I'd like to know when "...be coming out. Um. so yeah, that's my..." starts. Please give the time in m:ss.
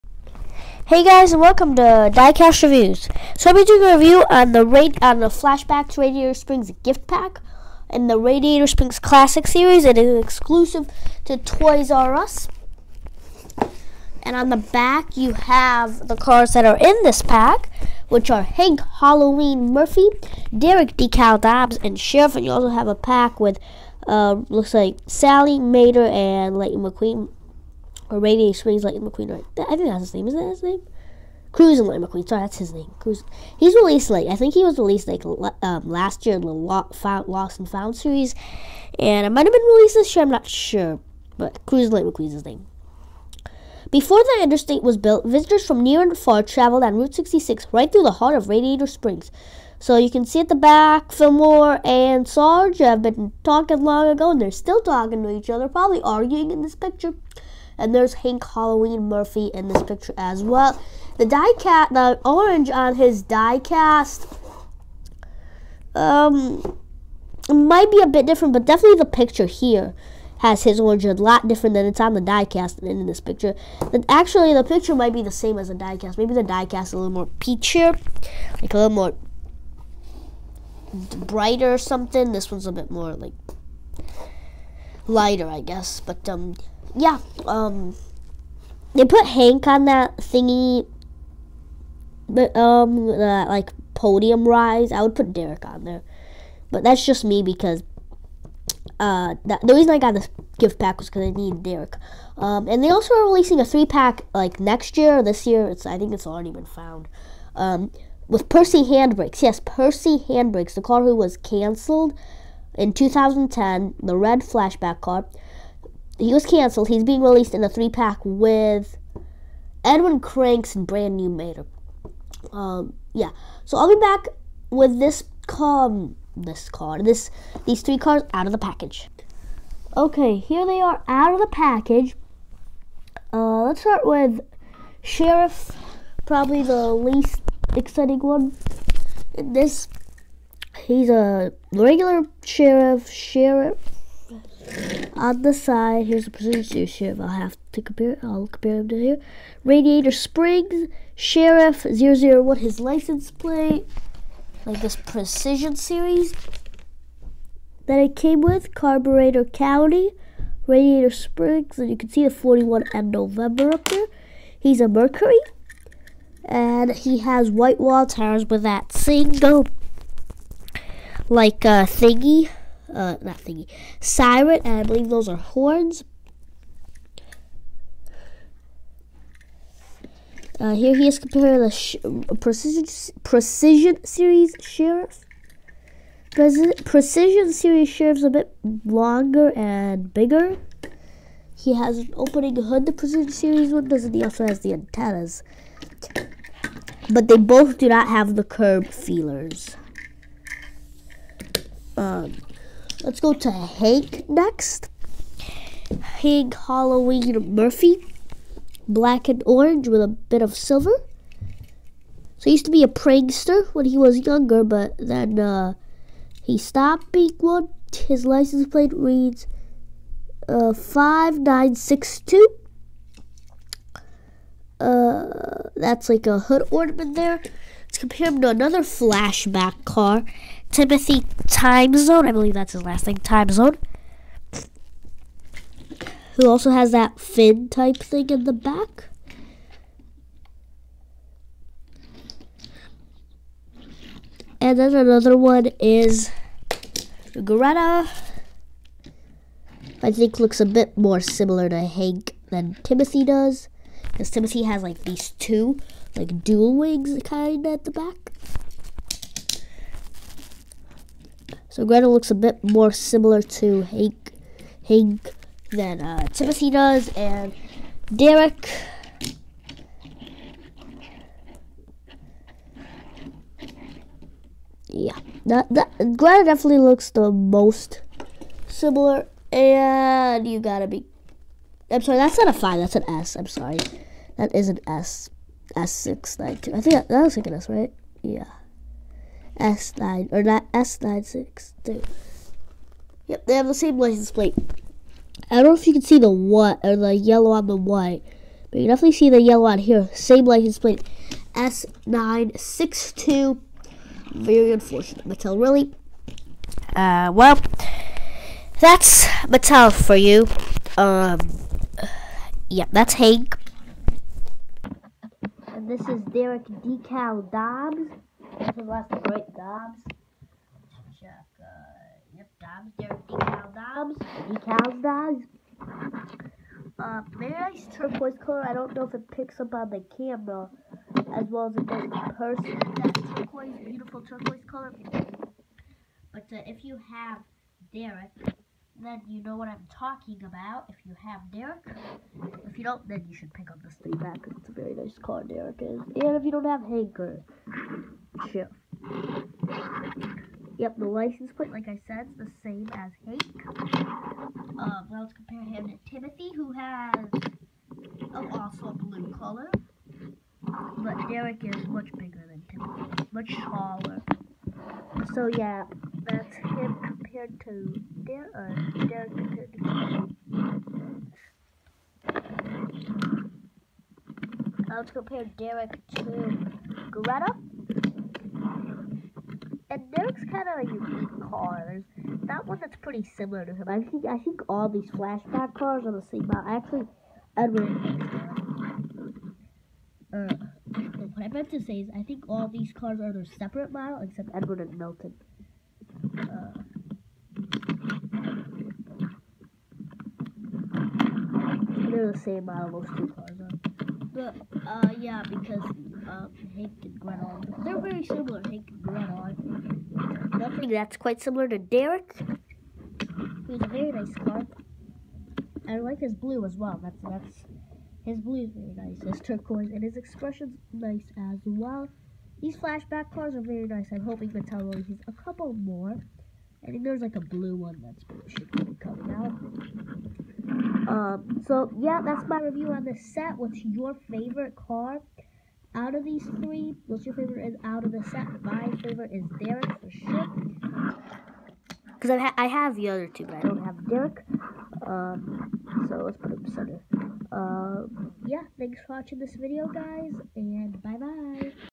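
7:08.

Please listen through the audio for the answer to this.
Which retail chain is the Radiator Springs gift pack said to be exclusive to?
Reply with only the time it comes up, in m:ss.
0:11.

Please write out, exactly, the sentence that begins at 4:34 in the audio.
Yeah, that, that Gretel definitely looks the most similar, and you gotta be I'm sorry, that's not a 5, that's an S.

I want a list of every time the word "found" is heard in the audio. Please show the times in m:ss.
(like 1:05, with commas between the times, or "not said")
0:37, 1:46.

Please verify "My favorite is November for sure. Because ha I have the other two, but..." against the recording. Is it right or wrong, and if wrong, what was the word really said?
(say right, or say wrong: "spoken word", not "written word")
wrong: "Derek", not "November".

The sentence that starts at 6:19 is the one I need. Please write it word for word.
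And Derek's kind of a unique car.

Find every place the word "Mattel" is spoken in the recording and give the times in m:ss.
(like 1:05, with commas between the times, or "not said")
5:05, 5:09, 7:04.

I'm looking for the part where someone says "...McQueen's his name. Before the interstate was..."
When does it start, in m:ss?
0:42.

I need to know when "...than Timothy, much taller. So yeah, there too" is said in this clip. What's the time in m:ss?
6:02.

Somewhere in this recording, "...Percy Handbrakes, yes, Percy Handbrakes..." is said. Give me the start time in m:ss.
1:48.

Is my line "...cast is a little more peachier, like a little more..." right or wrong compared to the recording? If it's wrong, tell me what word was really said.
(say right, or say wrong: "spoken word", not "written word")
right.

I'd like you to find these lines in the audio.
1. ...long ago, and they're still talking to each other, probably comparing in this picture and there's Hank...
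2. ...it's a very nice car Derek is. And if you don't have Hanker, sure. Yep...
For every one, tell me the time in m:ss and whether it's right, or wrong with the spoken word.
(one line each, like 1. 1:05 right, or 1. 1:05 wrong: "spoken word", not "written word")
1. 0:53 wrong: "arguing", not "comparing"
2. 5:44 right.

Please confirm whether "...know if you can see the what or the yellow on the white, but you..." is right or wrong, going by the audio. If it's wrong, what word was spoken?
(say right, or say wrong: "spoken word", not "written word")
right.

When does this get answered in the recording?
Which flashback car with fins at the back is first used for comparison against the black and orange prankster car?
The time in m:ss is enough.
3:50.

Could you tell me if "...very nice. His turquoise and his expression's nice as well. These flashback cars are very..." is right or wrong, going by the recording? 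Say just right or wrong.
right.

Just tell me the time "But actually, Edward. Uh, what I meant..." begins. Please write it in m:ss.
6:26.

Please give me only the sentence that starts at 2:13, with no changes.
Uh, let's start with Sheriff, probably the least exciting one in this he's a regular sheriff, sheriff on the side.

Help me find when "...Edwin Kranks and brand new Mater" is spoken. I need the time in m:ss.
1:59.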